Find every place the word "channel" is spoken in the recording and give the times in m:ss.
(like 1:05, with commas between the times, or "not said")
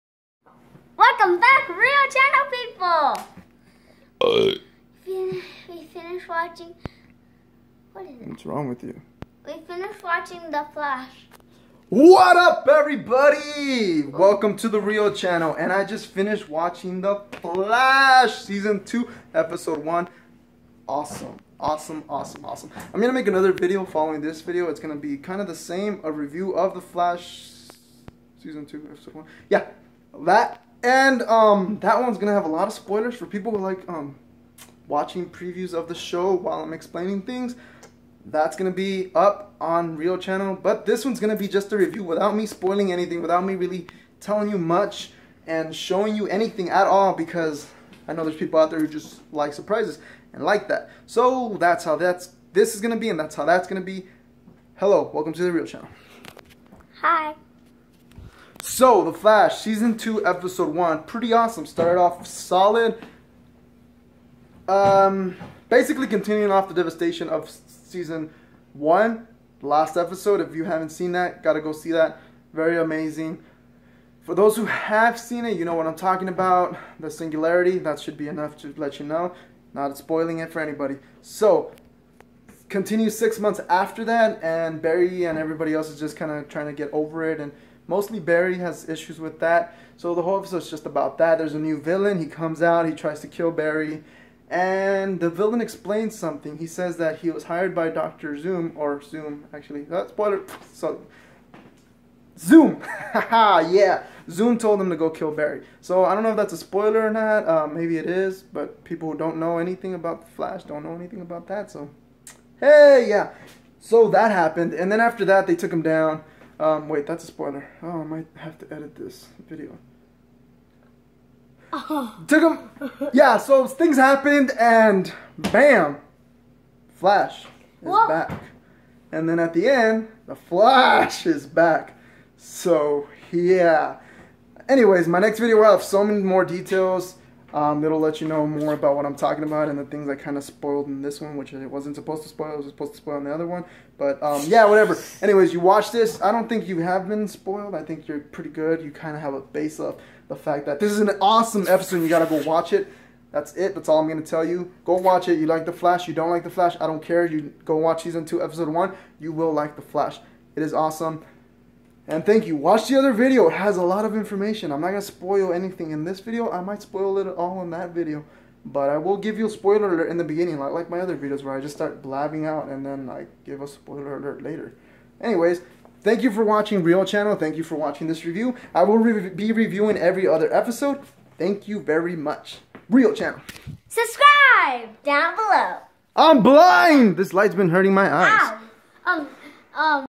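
0:02, 0:15, 0:40, 0:55, 2:57, 3:03.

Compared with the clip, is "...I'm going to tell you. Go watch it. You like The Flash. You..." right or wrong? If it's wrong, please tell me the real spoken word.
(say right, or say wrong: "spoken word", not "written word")
right.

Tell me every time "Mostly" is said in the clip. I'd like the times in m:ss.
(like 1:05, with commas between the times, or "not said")
1:27.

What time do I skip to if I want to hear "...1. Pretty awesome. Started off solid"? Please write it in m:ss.
1:00.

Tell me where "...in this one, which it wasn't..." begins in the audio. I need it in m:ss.
2:20.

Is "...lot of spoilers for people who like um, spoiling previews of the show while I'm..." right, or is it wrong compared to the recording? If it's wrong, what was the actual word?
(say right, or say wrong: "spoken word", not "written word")
wrong: "watching", not "spoiling".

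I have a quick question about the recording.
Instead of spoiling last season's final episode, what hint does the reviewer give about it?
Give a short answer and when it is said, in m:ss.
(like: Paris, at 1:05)
The singularity, at 1:16.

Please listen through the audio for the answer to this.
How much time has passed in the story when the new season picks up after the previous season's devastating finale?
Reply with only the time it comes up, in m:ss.
1:23.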